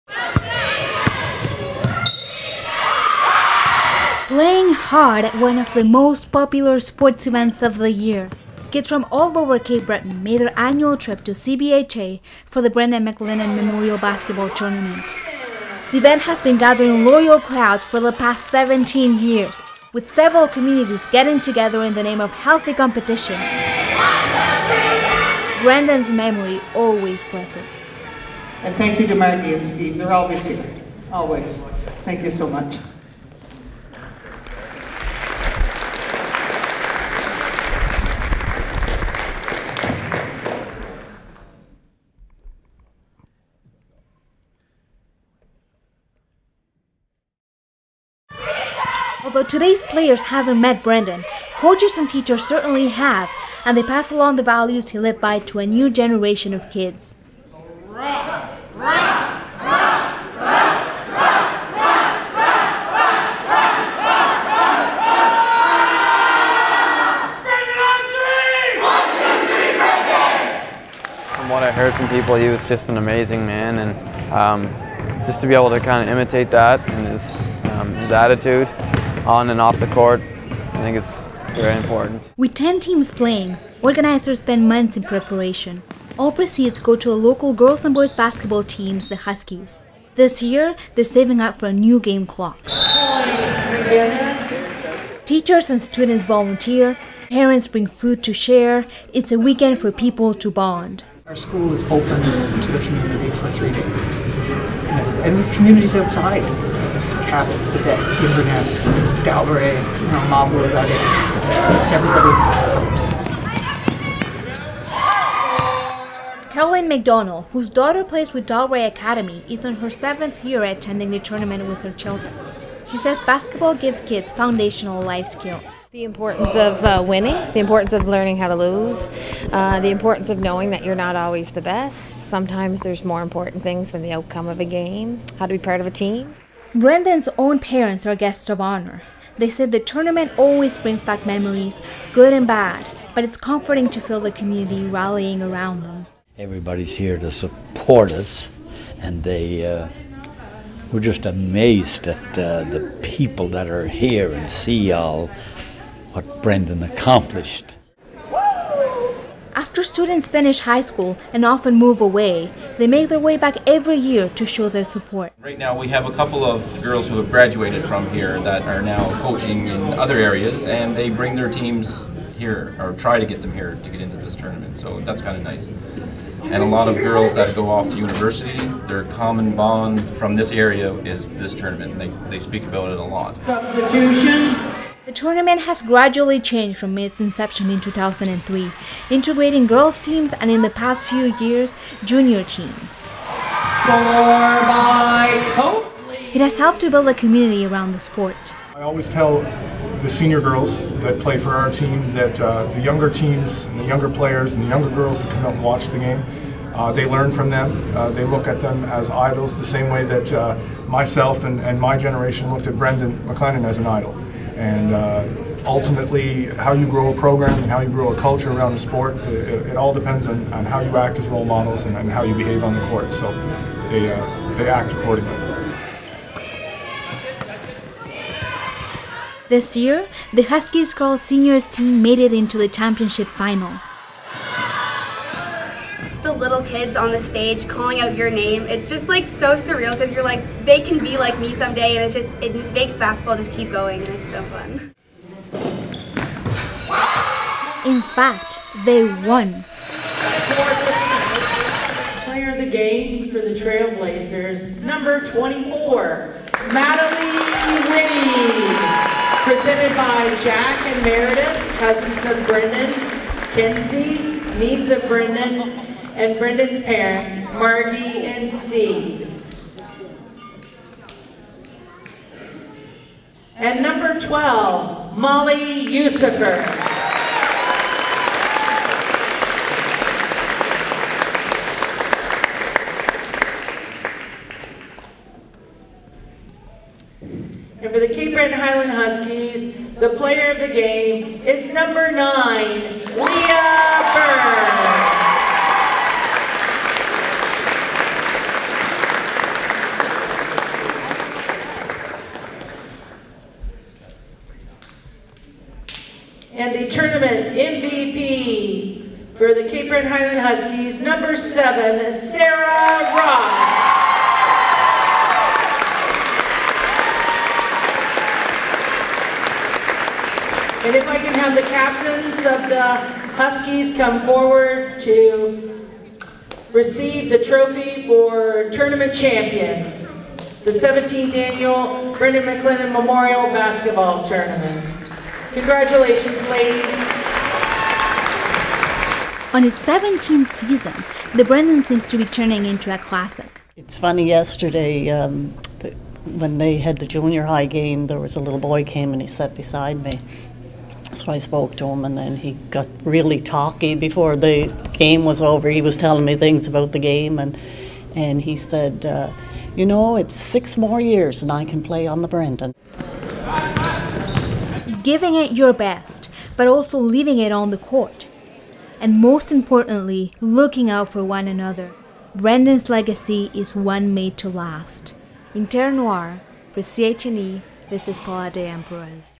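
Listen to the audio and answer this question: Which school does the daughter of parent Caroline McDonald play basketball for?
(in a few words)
Dalbrae Academy.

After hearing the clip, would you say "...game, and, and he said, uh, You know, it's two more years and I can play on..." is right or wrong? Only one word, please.
wrong.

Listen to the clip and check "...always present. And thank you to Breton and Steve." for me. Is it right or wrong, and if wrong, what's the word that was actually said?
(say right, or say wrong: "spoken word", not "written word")
wrong: "Maggie", not "Breton".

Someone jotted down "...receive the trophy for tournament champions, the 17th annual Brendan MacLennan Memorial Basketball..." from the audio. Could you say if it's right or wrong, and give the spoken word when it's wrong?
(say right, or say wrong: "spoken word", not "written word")
right.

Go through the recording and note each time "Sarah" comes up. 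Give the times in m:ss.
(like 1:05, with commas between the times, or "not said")
5:12.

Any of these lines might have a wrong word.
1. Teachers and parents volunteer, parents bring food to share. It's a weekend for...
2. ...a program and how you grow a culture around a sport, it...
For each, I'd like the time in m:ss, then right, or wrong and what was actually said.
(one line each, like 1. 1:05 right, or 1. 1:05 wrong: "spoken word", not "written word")
1. 1:35 wrong: "students", not "parents"
2. 3:37 right.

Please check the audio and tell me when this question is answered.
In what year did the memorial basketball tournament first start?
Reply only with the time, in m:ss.
3:07.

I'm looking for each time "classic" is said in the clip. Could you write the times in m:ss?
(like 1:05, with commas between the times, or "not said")
5:42.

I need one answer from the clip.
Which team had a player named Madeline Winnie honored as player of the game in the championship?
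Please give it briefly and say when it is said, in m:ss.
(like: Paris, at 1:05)
Trailblazers, at 4:13.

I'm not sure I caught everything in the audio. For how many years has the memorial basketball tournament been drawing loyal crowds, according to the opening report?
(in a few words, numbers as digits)
17.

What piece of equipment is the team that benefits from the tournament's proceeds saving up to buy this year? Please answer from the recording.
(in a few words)
new game clock.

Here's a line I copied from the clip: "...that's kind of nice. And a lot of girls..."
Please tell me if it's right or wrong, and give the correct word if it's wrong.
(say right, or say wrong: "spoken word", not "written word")
right.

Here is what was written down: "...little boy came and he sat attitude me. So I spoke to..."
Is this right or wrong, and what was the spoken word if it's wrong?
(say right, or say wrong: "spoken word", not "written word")
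wrong: "beside", not "attitude".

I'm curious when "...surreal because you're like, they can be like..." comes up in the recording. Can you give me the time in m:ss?
3:59.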